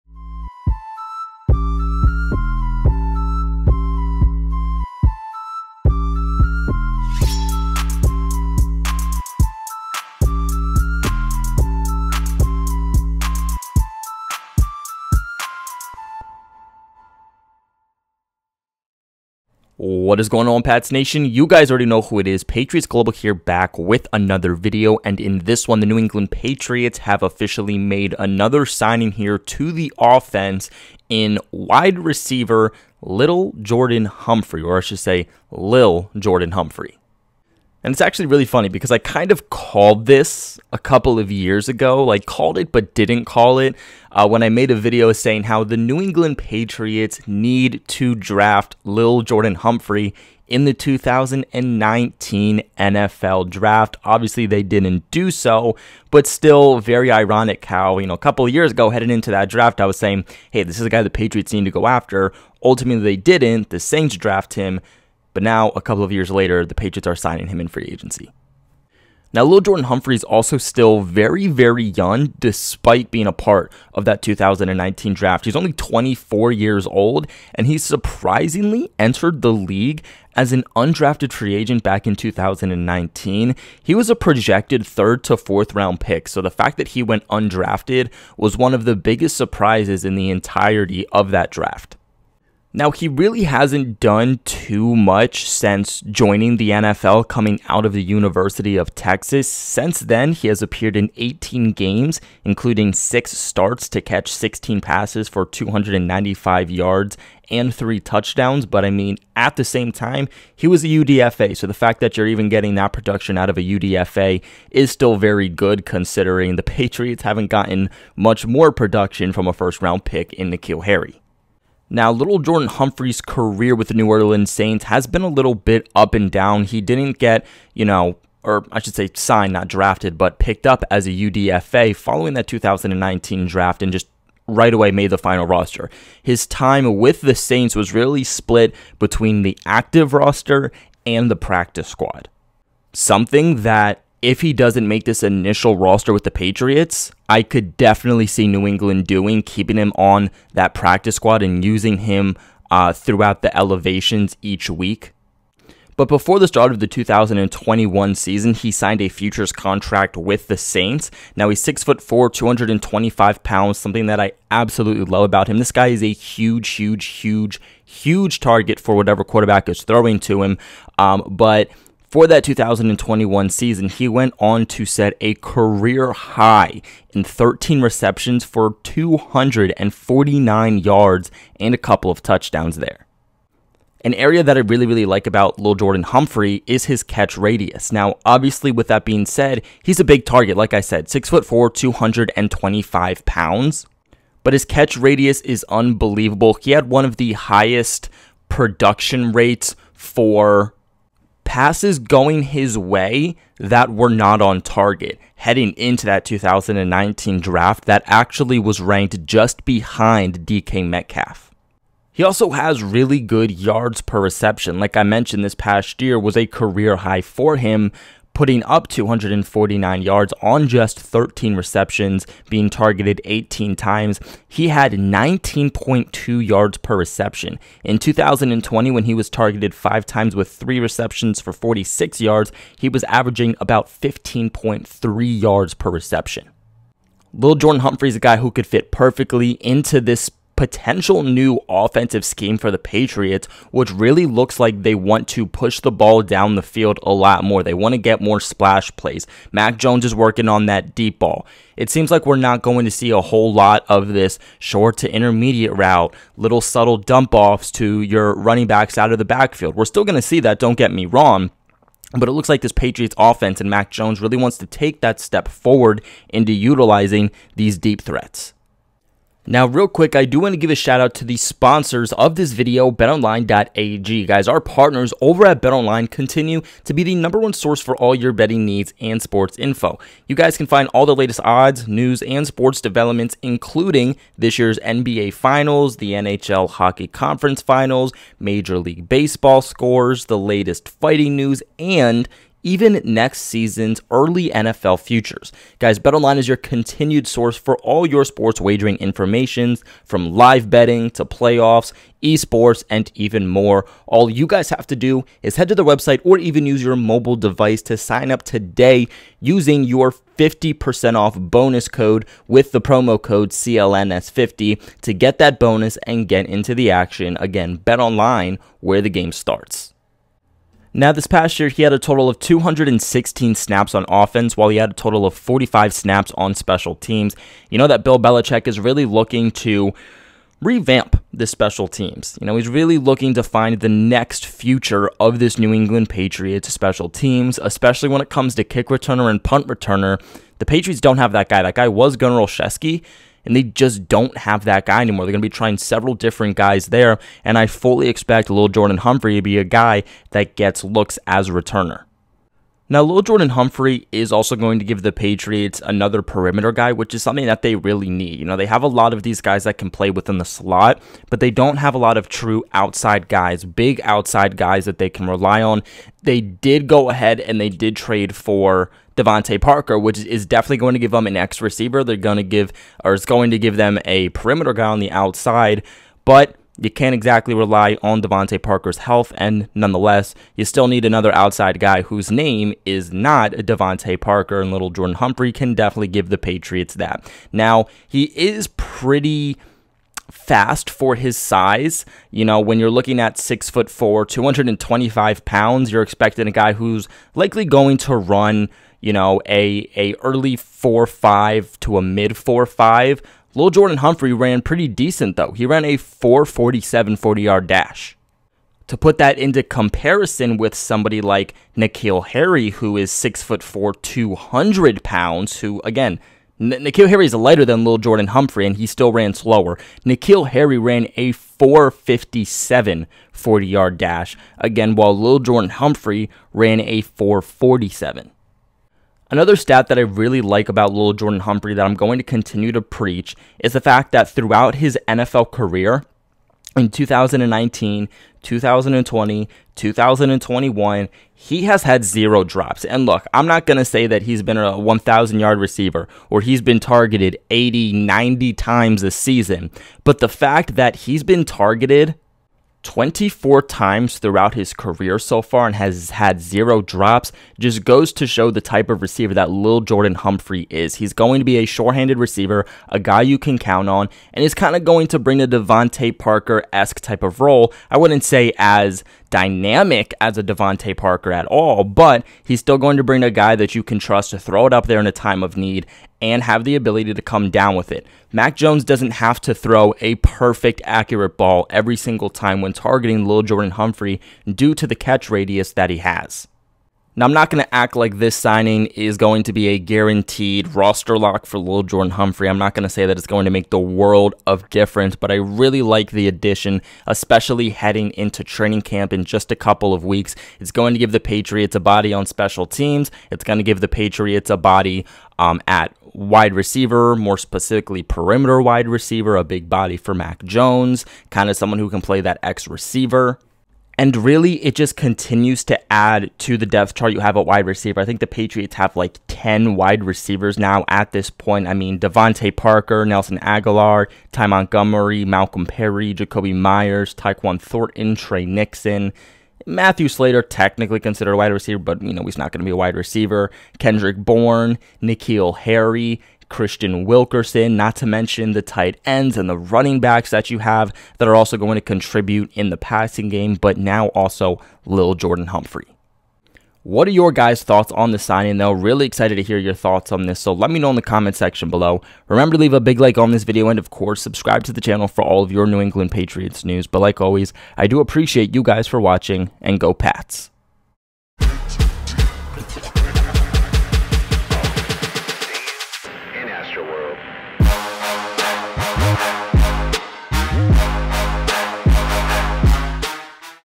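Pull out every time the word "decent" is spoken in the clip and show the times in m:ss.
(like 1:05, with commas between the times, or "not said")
6:44.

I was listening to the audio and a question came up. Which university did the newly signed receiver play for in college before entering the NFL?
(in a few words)
University of Texas.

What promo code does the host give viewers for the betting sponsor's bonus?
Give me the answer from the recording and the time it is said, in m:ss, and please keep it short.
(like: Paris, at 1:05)
CLNS50, at 5:13.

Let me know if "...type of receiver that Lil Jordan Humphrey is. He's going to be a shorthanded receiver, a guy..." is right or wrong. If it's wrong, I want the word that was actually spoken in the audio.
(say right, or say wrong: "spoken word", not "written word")
right.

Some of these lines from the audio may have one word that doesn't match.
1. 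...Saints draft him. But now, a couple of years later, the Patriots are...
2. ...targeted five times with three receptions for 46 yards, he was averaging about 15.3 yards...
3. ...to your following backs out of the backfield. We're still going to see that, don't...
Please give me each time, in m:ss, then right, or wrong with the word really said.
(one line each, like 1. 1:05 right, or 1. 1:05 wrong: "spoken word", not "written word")
1. 1:03 right
2. 3:49 right
3. 4:17 wrong: "running", not "following".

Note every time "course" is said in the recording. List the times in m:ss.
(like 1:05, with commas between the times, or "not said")
9:13.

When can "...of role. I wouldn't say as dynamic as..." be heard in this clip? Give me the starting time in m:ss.
7:47.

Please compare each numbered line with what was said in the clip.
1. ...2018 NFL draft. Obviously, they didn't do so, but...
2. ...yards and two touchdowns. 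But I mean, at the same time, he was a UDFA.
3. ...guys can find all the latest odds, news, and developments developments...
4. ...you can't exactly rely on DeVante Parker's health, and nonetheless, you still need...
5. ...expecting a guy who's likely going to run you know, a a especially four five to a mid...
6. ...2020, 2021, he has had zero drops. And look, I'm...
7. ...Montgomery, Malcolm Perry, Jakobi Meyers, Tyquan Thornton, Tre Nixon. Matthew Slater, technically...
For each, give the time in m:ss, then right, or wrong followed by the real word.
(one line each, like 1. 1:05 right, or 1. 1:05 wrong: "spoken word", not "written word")
1. 0:50 wrong: "2019", not "2018"
2. 1:46 wrong: "three", not "two"
3. 4:40 wrong: "sports", not "developments"
4. 6:16 right
5. 6:36 wrong: "early", not "especially"
6. 7:18 right
7. 8:44 right.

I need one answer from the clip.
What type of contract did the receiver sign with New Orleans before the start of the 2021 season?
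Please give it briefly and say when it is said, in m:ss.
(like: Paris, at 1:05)
Futures contract, at 2:39.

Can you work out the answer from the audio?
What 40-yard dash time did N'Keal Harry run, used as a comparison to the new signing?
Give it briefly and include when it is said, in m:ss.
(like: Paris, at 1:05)
4.57, at 7:01.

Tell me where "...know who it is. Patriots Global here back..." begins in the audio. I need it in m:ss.
0:21.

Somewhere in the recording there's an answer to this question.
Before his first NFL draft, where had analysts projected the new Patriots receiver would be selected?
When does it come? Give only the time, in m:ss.
1:24.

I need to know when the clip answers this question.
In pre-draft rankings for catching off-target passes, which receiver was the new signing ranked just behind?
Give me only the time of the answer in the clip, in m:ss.
3:30.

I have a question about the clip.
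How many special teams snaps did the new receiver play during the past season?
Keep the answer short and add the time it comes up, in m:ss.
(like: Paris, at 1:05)
45, at 5:25.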